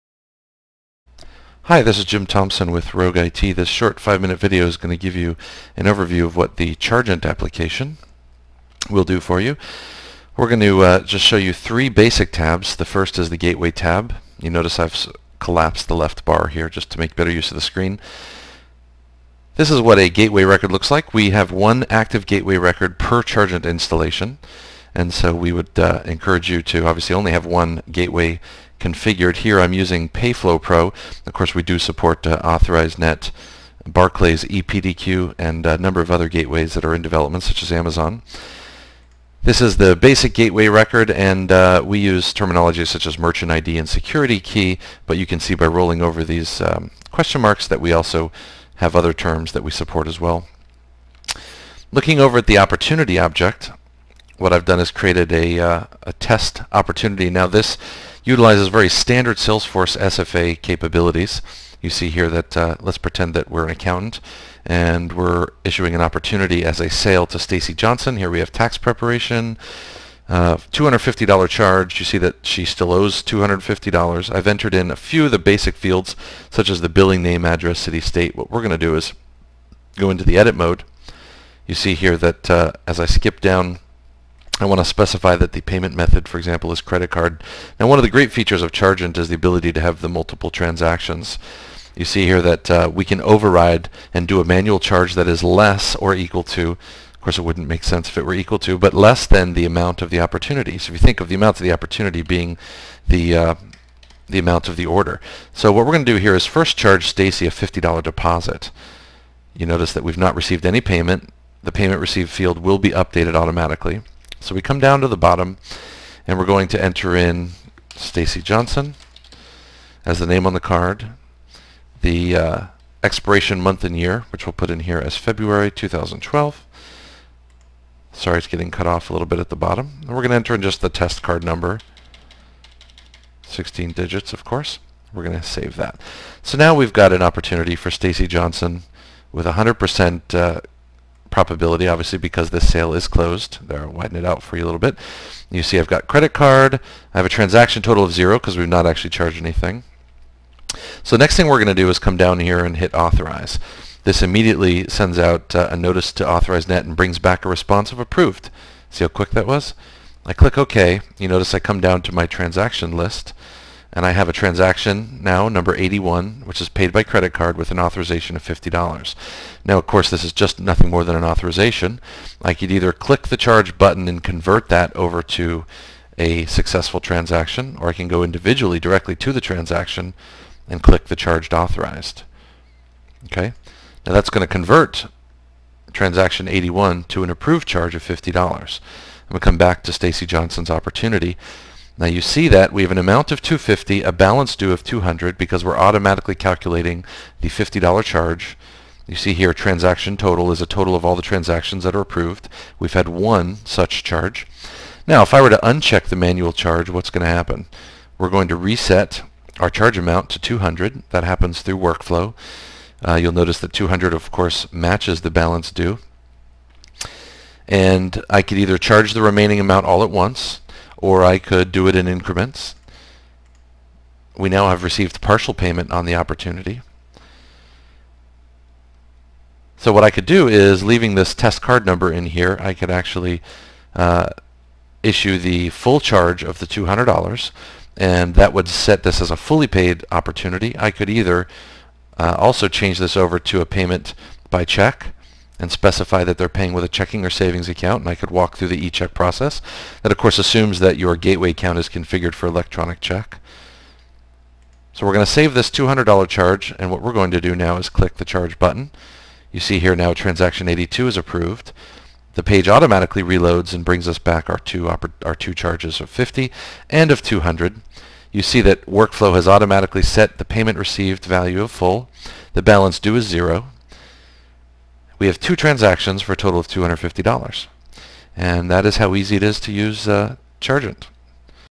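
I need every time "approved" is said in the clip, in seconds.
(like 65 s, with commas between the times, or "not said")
157 s, 187 s, 202 s, 261 s.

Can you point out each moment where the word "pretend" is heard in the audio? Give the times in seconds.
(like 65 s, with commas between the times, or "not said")
62 s.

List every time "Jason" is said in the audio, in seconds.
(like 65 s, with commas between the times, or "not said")
not said.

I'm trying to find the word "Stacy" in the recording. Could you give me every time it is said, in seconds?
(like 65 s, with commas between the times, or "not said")
67 s, 107 s, 117 s, 137 s, 189 s.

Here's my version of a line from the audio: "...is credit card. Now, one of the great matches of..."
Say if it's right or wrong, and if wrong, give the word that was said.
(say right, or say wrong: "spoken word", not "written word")
wrong: "features", not "matches".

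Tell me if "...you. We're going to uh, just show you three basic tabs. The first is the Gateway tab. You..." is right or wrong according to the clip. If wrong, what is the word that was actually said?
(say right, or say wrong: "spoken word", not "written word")
right.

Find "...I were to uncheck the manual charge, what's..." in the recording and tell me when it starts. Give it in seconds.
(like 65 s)
205 s.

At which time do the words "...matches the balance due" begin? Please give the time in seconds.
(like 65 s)
214 s.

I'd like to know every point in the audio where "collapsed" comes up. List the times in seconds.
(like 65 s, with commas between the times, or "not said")
15 s.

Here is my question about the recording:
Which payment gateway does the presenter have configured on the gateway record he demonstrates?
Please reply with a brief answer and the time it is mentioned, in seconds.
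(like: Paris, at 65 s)
Payflow Pro, at 30 s.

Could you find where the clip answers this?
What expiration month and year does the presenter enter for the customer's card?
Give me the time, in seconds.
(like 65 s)
125 s.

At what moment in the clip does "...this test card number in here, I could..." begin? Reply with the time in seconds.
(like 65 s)
231 s.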